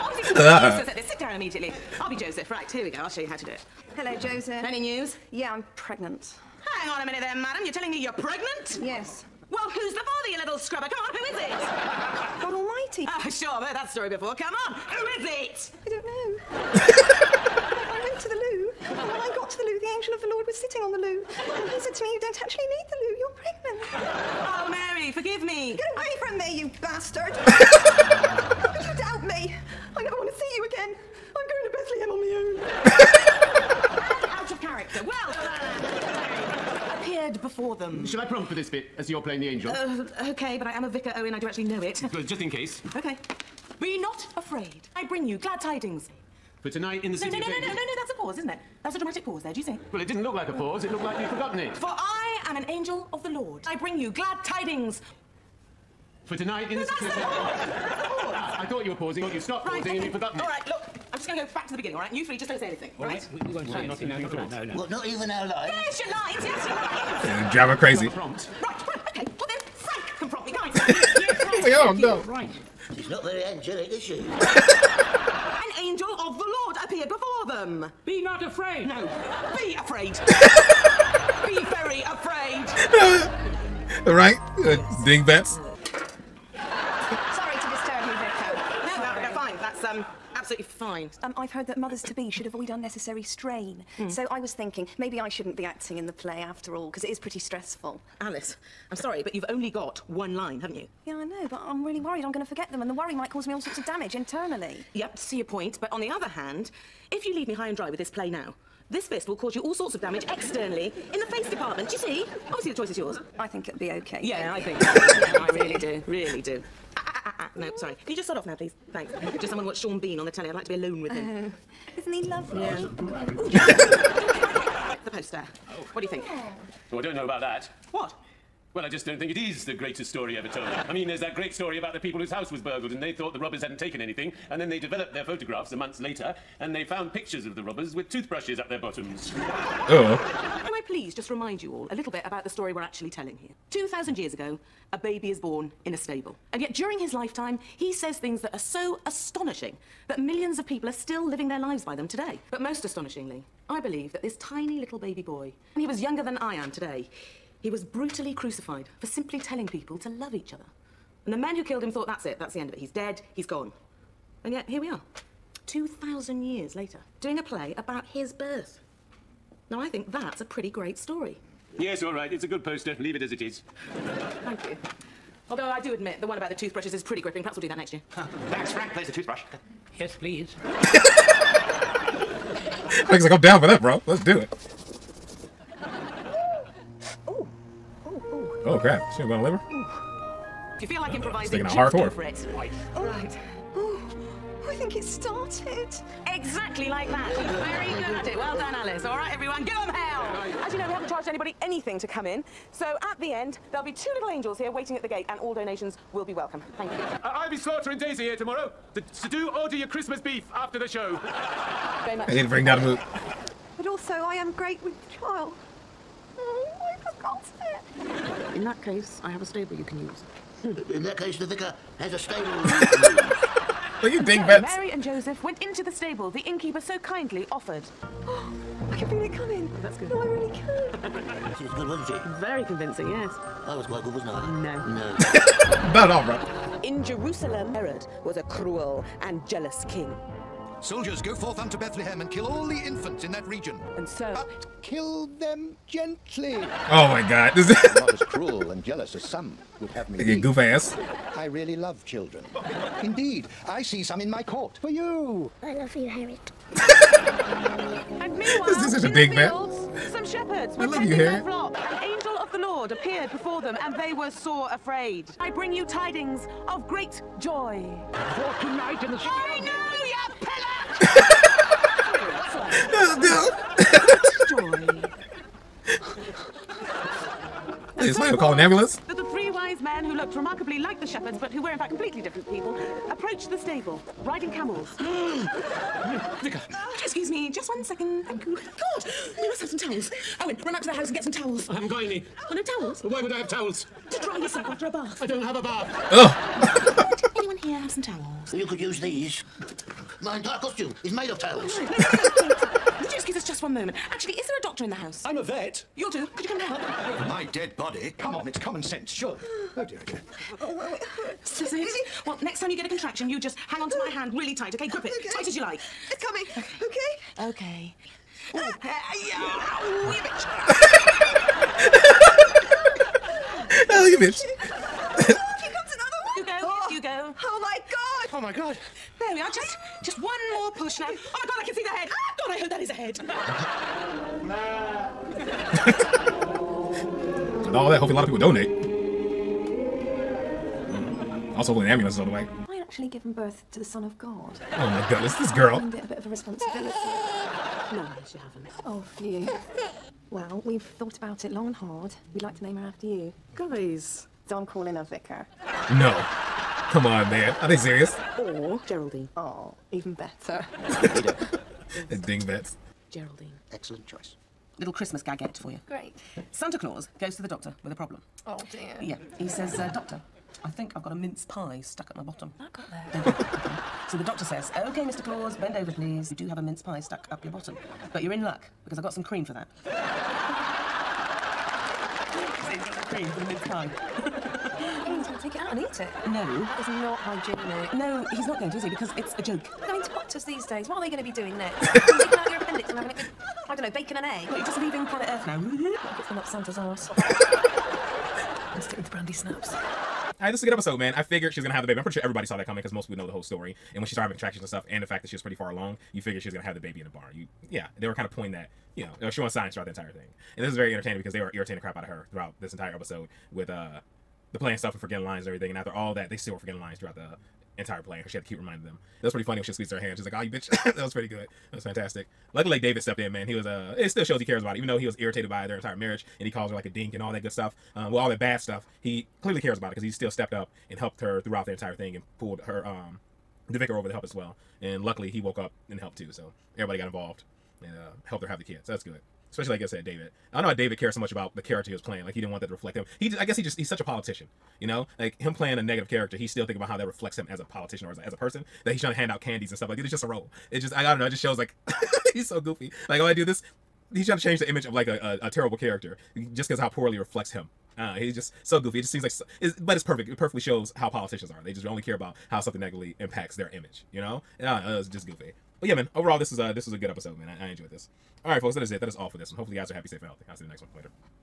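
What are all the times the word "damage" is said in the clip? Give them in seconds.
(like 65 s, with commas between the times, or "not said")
103 s, 109 s.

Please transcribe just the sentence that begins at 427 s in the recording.
Um, well, all that bad stuff.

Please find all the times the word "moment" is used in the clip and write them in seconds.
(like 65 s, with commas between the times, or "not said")
303 s.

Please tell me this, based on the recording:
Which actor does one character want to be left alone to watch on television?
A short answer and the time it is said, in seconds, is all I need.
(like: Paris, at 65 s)
Sean Bean, at 119 s.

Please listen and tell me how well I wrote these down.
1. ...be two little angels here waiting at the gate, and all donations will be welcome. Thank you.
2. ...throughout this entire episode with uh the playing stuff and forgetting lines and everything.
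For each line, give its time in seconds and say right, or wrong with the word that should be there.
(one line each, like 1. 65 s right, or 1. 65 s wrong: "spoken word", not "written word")
1. 203 s right
2. 412 s right.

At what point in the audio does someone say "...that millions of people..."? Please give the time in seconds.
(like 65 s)
150 s.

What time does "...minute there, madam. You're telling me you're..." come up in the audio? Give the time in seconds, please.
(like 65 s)
7 s.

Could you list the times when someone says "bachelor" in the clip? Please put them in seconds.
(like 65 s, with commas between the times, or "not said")
not said.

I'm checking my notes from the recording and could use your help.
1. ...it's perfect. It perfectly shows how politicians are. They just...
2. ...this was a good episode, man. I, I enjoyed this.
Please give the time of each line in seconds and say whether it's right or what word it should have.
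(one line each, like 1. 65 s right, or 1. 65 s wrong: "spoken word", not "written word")
1. 459 s right
2. 466 s right.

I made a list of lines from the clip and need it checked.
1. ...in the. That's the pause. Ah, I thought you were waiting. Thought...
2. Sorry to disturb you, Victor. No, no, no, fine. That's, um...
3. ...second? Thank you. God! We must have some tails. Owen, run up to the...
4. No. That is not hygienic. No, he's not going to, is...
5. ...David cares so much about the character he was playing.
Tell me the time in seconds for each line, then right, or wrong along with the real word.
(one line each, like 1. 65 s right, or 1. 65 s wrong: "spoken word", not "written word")
1. 56 s wrong: "pausing", not "waiting"
2. 85 s right
3. 287 s wrong: "towels", not "tails"
4. 386 s right
5. 440 s right.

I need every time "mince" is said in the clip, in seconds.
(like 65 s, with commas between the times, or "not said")
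371 s, 376 s, 383 s.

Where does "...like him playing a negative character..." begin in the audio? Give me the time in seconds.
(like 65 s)
445 s.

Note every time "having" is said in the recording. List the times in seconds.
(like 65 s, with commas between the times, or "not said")
392 s, 404 s.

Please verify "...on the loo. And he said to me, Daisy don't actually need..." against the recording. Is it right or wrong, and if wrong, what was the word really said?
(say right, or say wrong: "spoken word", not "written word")
wrong: "You", not "Daisy".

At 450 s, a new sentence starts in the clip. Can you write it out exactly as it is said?
It just, I, I don't know.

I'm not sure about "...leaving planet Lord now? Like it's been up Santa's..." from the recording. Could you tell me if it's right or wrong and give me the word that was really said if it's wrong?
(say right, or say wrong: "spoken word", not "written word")
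wrong: "Earth", not "Lord".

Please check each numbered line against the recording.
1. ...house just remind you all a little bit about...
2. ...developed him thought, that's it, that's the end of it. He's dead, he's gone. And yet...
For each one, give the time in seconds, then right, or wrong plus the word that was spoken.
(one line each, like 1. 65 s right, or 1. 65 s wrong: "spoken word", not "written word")
1. 140 s wrong: "please", not "house"
2. 161 s wrong: "killed", not "developed".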